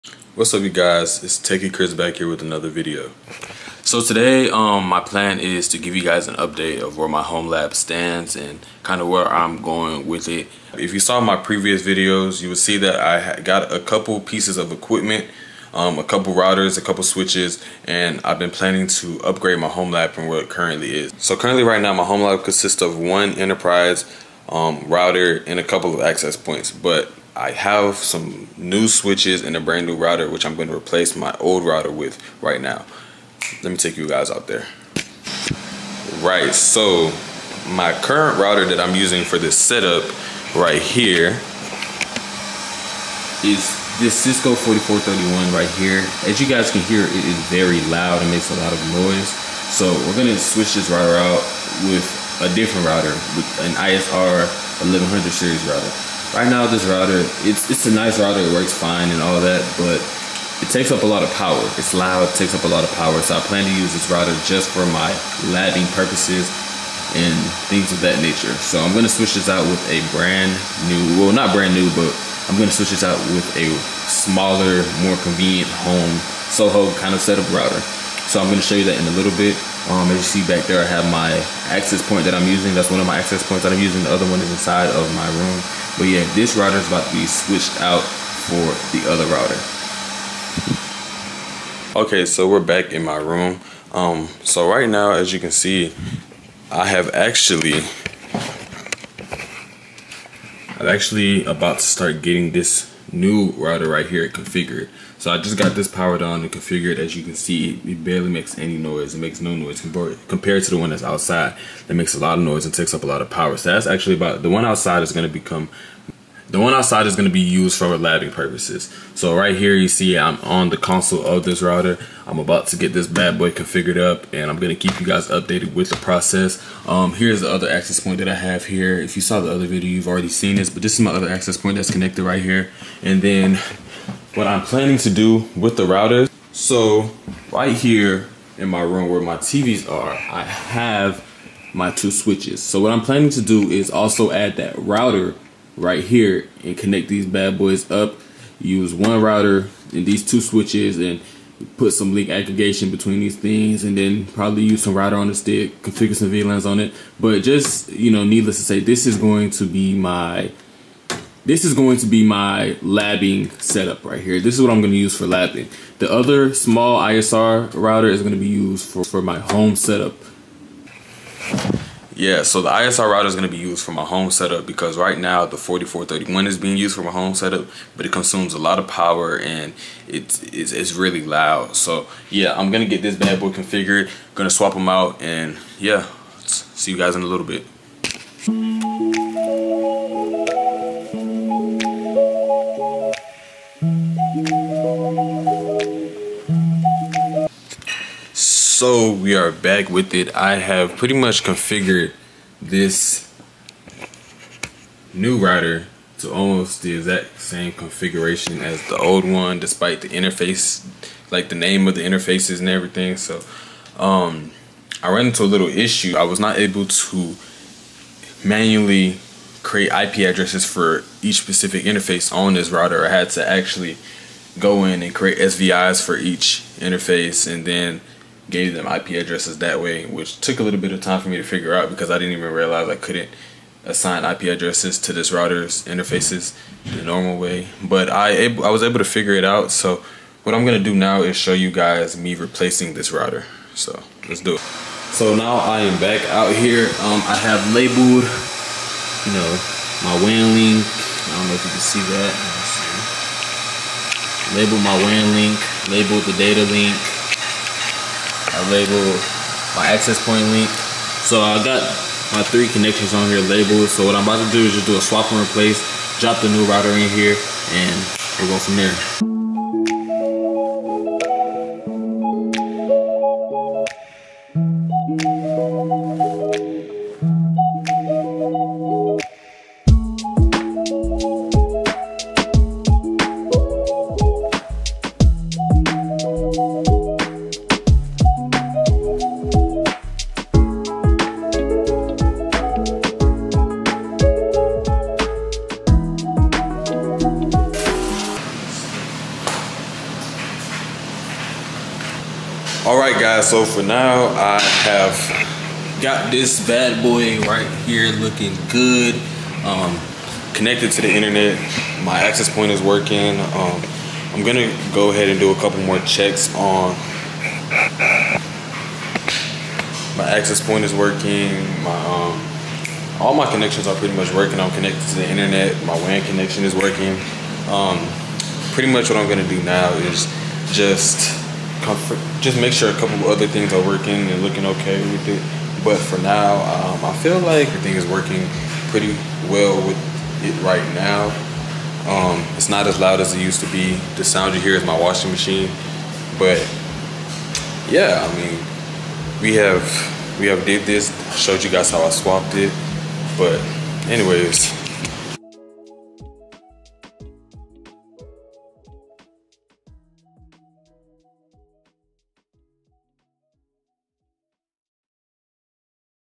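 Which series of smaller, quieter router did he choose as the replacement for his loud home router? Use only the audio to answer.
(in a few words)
ISR 1100 series.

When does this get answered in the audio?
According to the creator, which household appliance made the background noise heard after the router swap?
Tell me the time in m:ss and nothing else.
5:44.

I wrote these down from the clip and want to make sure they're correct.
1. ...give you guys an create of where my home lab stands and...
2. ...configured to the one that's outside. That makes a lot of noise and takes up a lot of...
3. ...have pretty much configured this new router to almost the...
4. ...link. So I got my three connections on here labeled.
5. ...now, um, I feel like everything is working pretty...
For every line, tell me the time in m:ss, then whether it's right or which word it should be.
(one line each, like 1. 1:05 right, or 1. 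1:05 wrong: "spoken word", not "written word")
1. 0:05 wrong: "update", not "create"
2. 1:49 wrong: "compared", not "configured"
3. 3:20 right
4. 4:20 right
5. 5:36 right.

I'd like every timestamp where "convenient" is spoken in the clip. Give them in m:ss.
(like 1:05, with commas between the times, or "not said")
1:15.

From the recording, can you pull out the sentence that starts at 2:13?
And then what I'm planning to do with the router.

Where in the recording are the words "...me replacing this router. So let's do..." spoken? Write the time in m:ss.
4:02.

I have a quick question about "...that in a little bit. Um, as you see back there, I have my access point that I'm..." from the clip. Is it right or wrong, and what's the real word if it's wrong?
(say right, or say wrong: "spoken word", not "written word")
right.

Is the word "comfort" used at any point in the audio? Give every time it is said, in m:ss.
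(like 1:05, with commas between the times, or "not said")
5:31.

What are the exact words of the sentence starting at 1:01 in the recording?
It's loud, it takes up a lot of power.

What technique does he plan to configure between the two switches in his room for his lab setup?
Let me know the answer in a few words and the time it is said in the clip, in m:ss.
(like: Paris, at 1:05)
Link aggregation, at 2:32.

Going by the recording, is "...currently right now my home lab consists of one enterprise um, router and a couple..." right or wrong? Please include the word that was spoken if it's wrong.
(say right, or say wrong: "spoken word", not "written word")
right.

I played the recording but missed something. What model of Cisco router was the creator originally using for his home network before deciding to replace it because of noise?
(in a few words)
Cisco 4431.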